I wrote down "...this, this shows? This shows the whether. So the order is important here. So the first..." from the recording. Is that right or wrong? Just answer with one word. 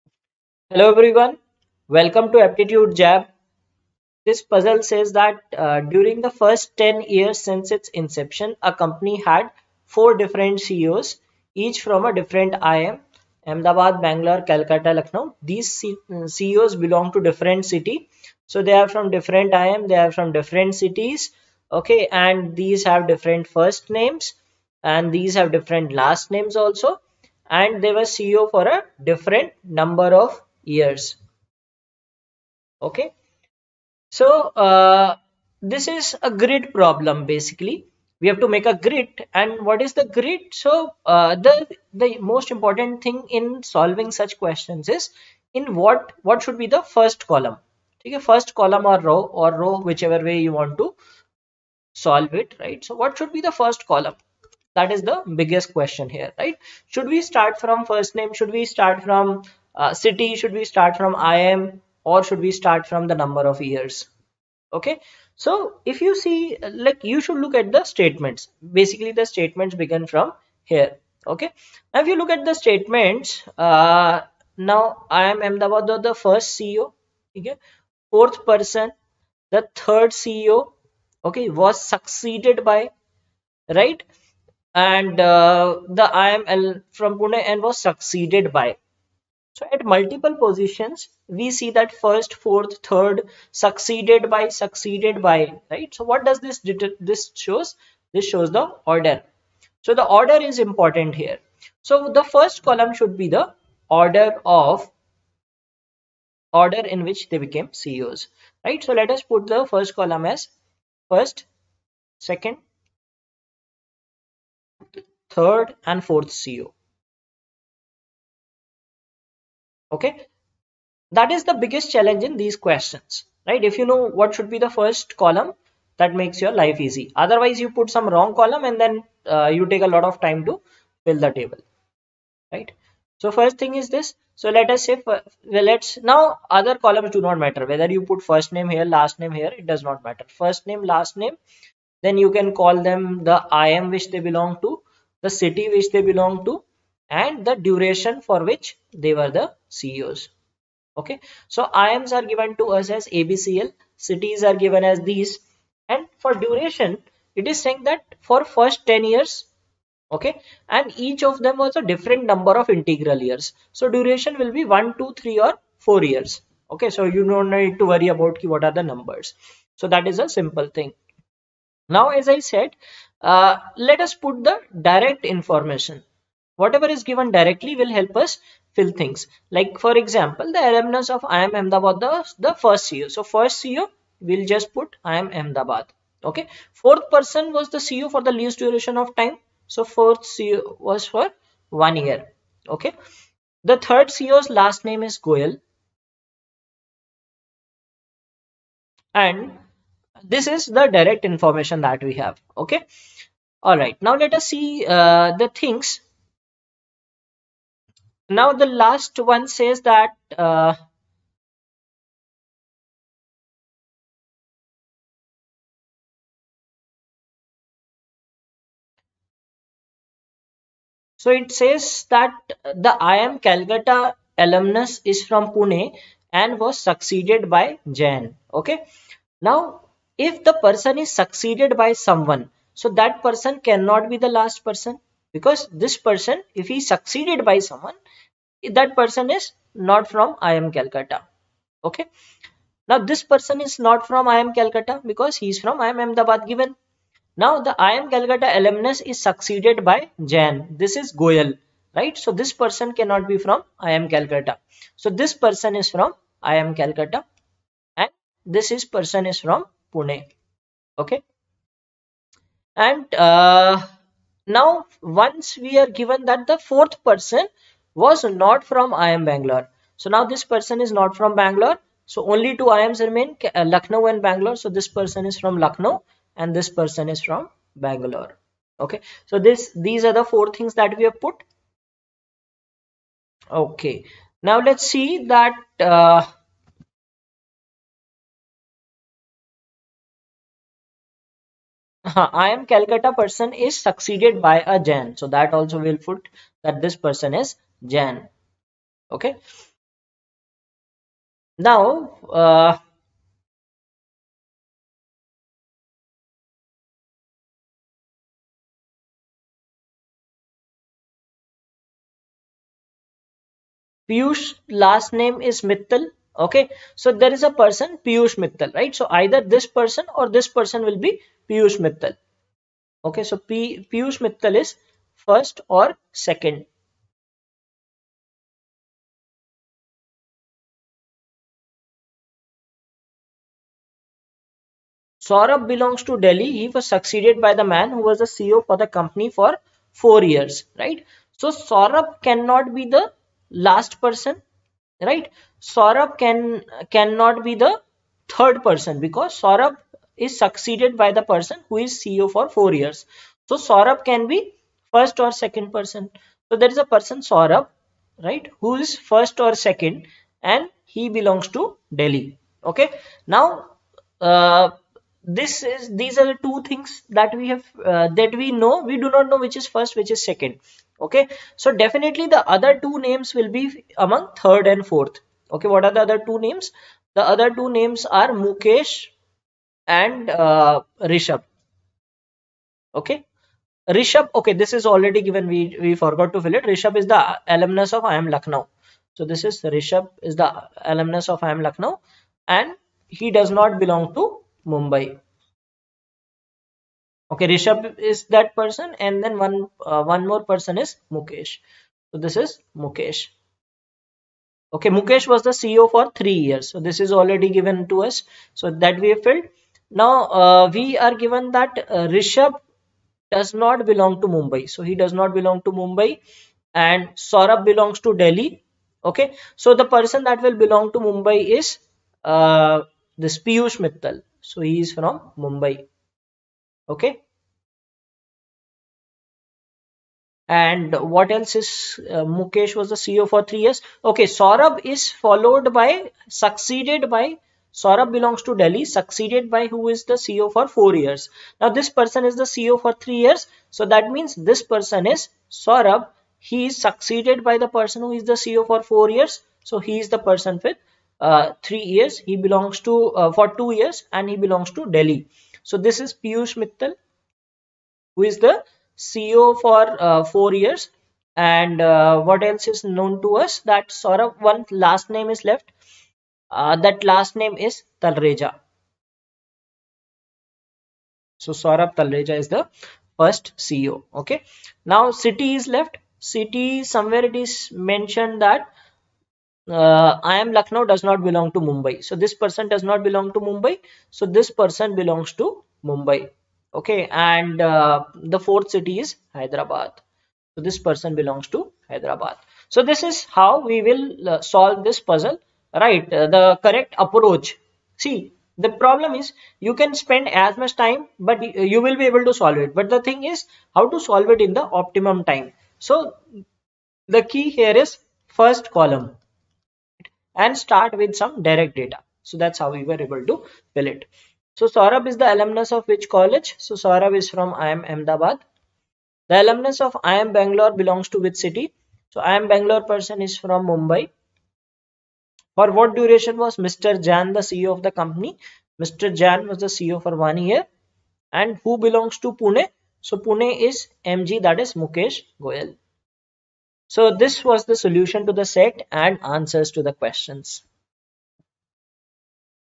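wrong.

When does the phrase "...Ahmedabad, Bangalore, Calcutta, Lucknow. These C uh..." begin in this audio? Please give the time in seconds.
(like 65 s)
13 s.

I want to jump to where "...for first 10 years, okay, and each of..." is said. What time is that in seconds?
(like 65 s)
158 s.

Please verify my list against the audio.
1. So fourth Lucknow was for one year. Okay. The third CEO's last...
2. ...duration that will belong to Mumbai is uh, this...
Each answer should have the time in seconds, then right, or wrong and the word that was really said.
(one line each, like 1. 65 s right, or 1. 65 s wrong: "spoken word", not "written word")
1. 189 s wrong: "CEO", not "Lucknow"
2. 419 s wrong: "person", not "duration".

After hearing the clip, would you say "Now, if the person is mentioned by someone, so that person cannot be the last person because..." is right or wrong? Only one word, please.
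wrong.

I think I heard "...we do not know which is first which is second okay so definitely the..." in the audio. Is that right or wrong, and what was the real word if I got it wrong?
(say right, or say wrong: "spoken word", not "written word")
right.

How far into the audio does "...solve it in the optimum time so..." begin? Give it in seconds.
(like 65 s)
503 s.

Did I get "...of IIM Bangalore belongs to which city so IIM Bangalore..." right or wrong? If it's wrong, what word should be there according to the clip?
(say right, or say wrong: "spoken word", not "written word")
right.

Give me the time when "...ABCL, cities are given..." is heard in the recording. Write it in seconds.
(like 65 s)
153 s.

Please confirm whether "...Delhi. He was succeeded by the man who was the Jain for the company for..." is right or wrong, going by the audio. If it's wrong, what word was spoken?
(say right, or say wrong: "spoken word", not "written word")
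wrong: "CEO", not "Jain".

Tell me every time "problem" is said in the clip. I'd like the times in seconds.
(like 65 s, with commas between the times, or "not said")
36 s, 498 s.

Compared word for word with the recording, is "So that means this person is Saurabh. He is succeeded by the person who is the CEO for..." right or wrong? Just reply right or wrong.
right.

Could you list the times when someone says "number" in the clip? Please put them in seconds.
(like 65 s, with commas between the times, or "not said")
29 s, 63 s, 162 s, 168 s.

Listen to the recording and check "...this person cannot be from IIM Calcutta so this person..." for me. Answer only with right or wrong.
right.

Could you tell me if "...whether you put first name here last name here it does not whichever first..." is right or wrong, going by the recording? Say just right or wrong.
wrong.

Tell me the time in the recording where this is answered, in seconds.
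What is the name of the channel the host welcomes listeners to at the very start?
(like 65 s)
2 s.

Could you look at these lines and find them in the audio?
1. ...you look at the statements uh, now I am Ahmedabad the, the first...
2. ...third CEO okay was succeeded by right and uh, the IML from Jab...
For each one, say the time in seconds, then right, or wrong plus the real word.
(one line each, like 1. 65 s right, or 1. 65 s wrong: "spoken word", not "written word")
1. 72 s right
2. 79 s wrong: "Pune", not "Jab".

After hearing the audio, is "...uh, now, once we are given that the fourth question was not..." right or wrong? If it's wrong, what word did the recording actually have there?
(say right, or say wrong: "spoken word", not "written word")
wrong: "person", not "question".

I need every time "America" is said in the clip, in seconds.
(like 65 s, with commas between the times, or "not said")
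not said.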